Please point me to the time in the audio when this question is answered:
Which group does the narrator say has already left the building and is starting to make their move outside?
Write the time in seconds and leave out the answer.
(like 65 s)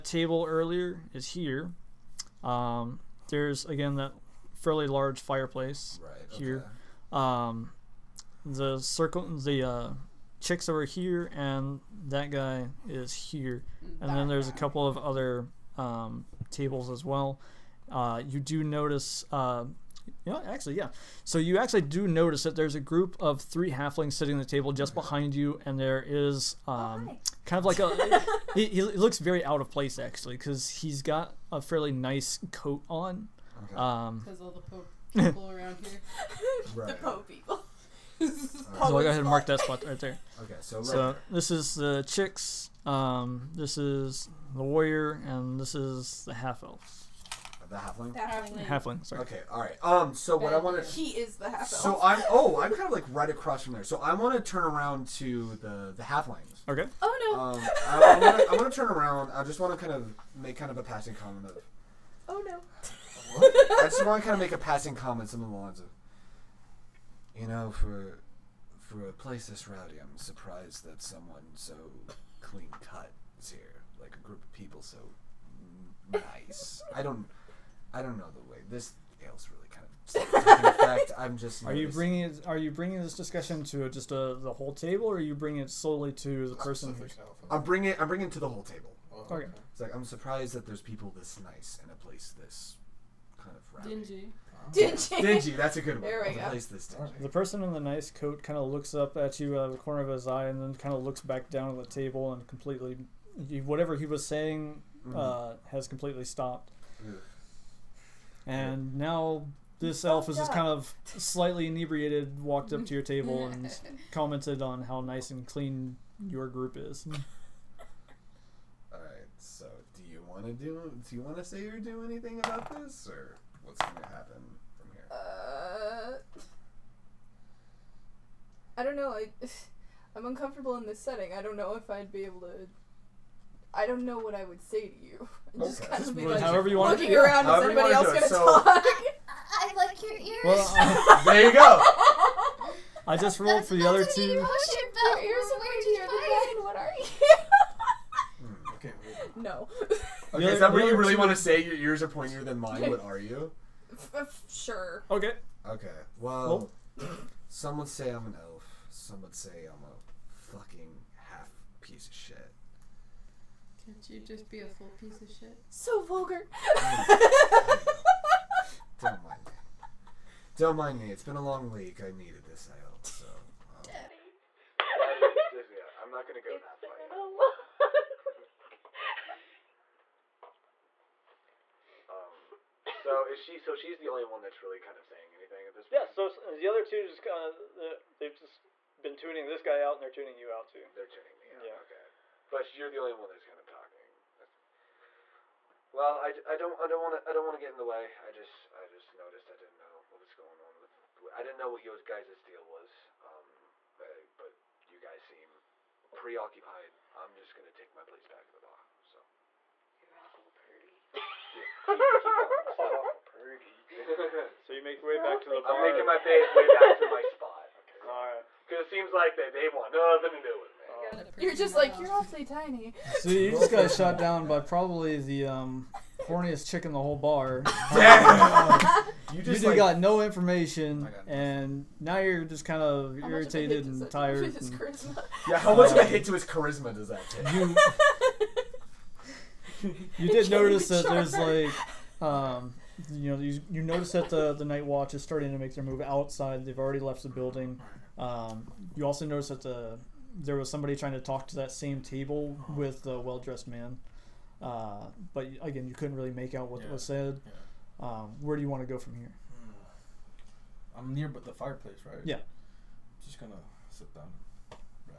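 244 s.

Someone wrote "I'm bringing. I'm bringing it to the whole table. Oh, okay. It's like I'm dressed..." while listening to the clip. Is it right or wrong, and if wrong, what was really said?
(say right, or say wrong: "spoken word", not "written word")
wrong: "surprised", not "dressed".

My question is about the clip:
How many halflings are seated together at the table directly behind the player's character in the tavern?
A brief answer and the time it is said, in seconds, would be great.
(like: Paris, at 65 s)
3, at 23 s.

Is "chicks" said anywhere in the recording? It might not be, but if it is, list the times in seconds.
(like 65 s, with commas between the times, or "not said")
10 s, 42 s, 226 s.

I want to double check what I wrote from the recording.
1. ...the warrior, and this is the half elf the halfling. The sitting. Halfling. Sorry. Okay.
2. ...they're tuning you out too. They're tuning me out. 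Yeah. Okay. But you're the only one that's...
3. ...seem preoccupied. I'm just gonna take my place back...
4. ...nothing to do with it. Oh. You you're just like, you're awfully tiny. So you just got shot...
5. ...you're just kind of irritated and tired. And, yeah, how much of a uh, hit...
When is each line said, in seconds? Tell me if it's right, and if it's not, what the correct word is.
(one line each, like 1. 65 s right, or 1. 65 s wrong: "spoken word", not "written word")
1. 44 s wrong: "halfling", not "sitting"
2. 190 s right
3. 205 s right
4. 219 s right
5. 232 s right.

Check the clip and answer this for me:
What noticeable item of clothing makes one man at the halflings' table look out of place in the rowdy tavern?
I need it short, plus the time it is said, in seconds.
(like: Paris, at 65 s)
a fairly nice coat, at 31 s.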